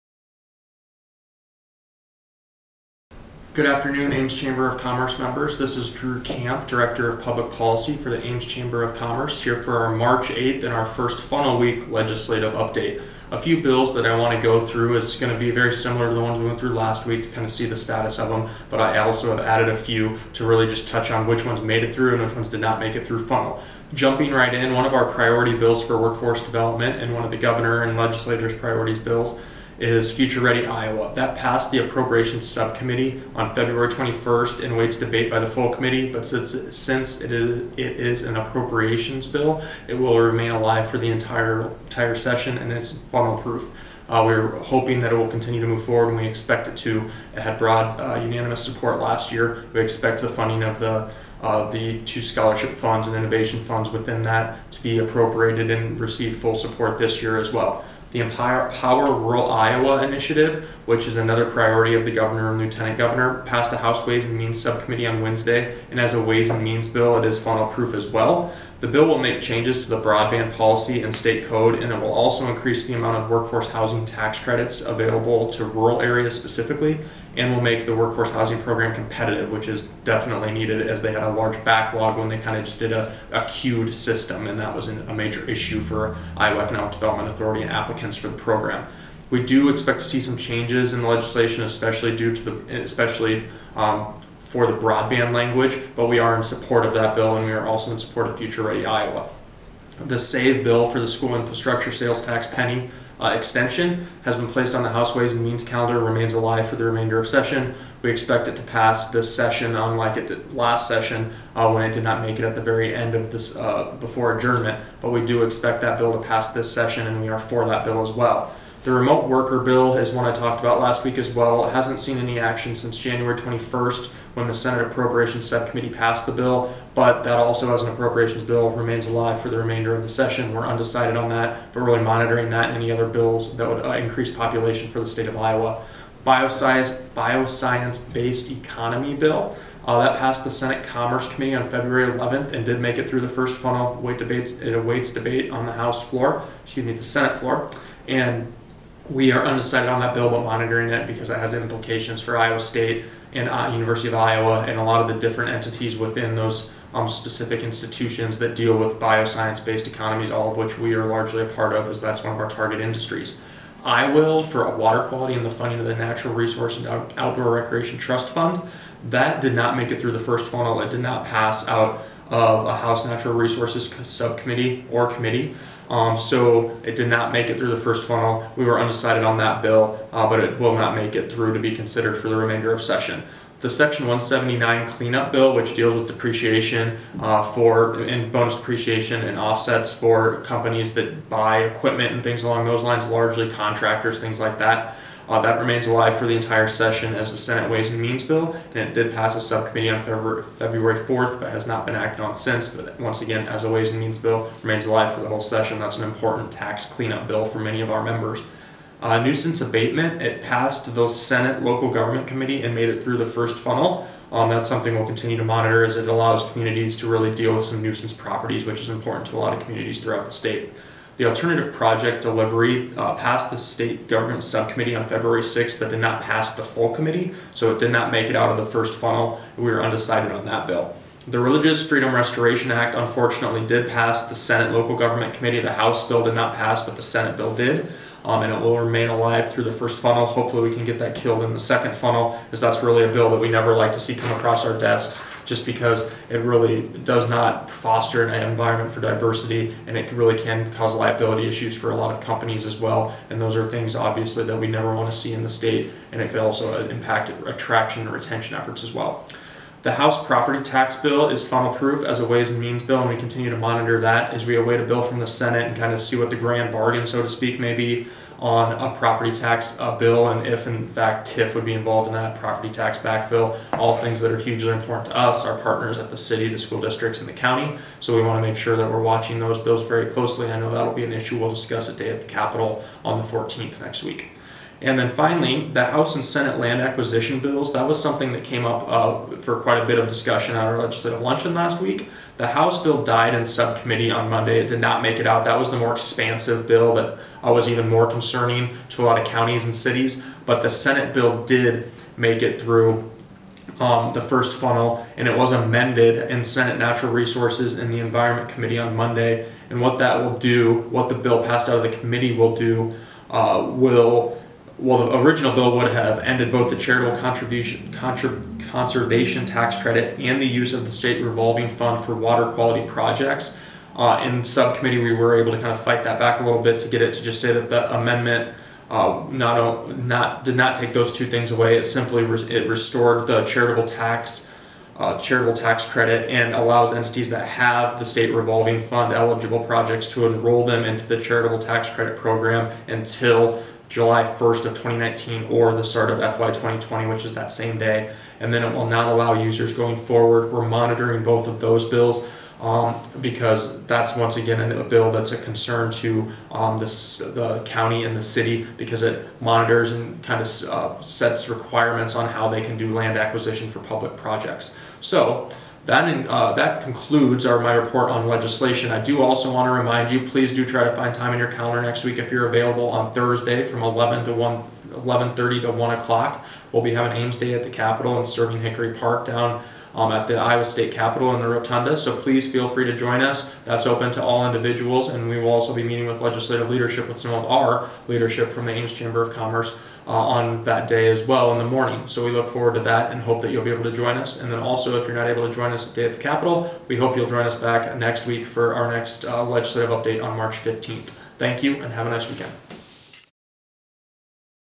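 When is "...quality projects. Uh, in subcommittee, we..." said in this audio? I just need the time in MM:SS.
05:22.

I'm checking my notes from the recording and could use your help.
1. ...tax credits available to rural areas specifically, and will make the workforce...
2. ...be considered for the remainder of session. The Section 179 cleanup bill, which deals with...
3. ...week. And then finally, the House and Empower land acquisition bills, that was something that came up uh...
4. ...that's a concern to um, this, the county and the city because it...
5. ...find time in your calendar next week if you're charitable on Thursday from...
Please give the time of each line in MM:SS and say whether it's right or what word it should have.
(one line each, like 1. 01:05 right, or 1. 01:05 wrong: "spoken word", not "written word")
1. 01:14 right
2. 03:01 right
3. 04:44 wrong: "Senate", not "Empower"
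4. 05:55 right
5. 06:10 wrong: "available", not "charitable".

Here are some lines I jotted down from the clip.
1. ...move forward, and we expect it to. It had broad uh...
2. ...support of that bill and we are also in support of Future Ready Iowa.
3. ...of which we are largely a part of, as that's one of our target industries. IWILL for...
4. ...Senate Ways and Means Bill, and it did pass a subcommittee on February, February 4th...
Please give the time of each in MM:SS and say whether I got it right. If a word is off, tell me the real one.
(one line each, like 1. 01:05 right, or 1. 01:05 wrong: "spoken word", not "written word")
1. 00:45 right
2. 01:36 right
3. 02:40 right
4. 03:17 right.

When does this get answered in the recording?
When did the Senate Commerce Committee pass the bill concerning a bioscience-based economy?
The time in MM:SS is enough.
02:21.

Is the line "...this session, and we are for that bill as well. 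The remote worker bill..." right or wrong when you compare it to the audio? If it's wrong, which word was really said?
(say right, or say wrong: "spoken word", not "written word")
right.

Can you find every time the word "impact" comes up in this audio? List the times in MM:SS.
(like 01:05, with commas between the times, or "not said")
04:16.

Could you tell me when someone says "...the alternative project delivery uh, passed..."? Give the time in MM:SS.
03:41.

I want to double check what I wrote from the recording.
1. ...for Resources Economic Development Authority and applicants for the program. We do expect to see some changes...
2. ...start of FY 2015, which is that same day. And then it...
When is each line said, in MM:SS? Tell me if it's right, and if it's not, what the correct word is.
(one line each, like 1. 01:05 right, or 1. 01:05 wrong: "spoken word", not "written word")
1. 01:25 wrong: "Iowa", not "Resources"
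2. 05:45 wrong: "2020", not "2015".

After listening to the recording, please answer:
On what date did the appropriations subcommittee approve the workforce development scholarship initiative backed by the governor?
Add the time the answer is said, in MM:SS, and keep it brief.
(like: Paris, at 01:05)
February 21, at 00:33.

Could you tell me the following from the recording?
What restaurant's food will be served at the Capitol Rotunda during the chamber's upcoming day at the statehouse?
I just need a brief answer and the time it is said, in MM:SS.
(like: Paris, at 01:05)
Hickory Park, at 06:18.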